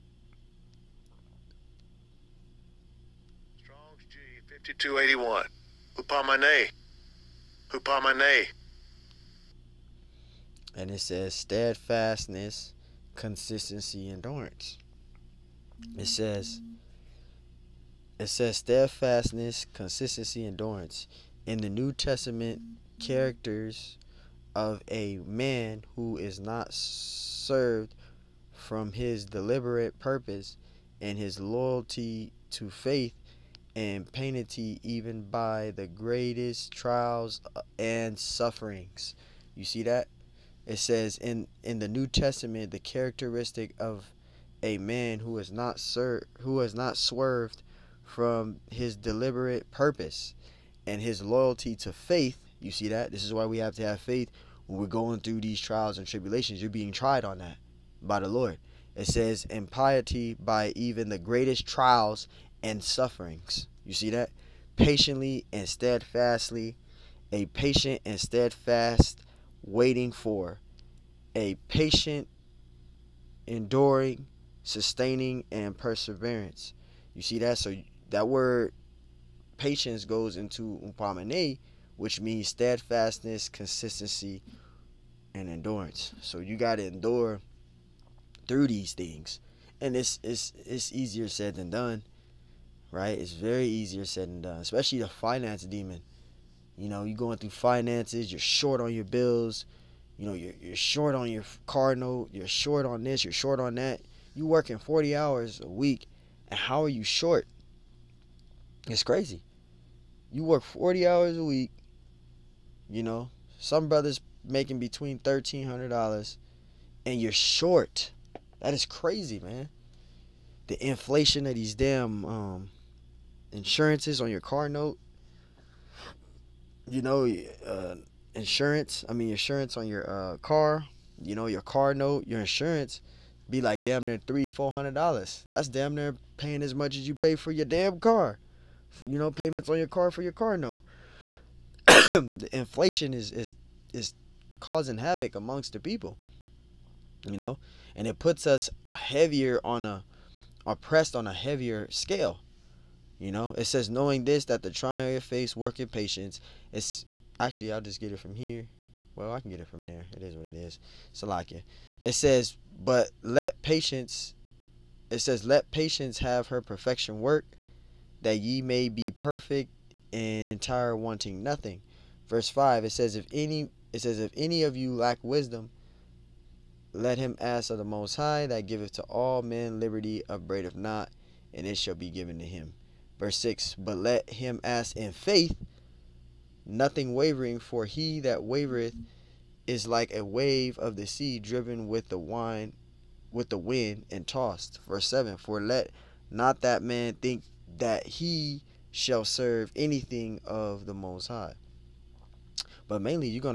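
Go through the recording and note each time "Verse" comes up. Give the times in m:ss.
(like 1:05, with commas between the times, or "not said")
2:52, 3:03, 3:14.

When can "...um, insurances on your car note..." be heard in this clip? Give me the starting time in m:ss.
2:02.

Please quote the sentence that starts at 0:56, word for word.
You're being tried on that by the Lord.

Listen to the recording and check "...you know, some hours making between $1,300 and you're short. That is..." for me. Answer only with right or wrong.
wrong.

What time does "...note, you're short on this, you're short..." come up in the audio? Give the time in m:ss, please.
1:41.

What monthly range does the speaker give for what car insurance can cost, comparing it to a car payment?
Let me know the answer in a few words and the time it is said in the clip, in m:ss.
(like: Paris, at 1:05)
$300-400, at 2:14.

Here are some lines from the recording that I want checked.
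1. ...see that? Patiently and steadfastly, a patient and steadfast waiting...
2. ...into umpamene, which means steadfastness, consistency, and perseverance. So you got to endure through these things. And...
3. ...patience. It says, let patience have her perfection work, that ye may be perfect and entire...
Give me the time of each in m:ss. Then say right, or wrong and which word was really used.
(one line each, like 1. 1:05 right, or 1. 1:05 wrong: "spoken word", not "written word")
1. 1:03 right
2. 1:20 wrong: "endurance", not "perseverance"
3. 2:43 right.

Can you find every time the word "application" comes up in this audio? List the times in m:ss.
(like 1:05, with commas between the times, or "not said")
not said.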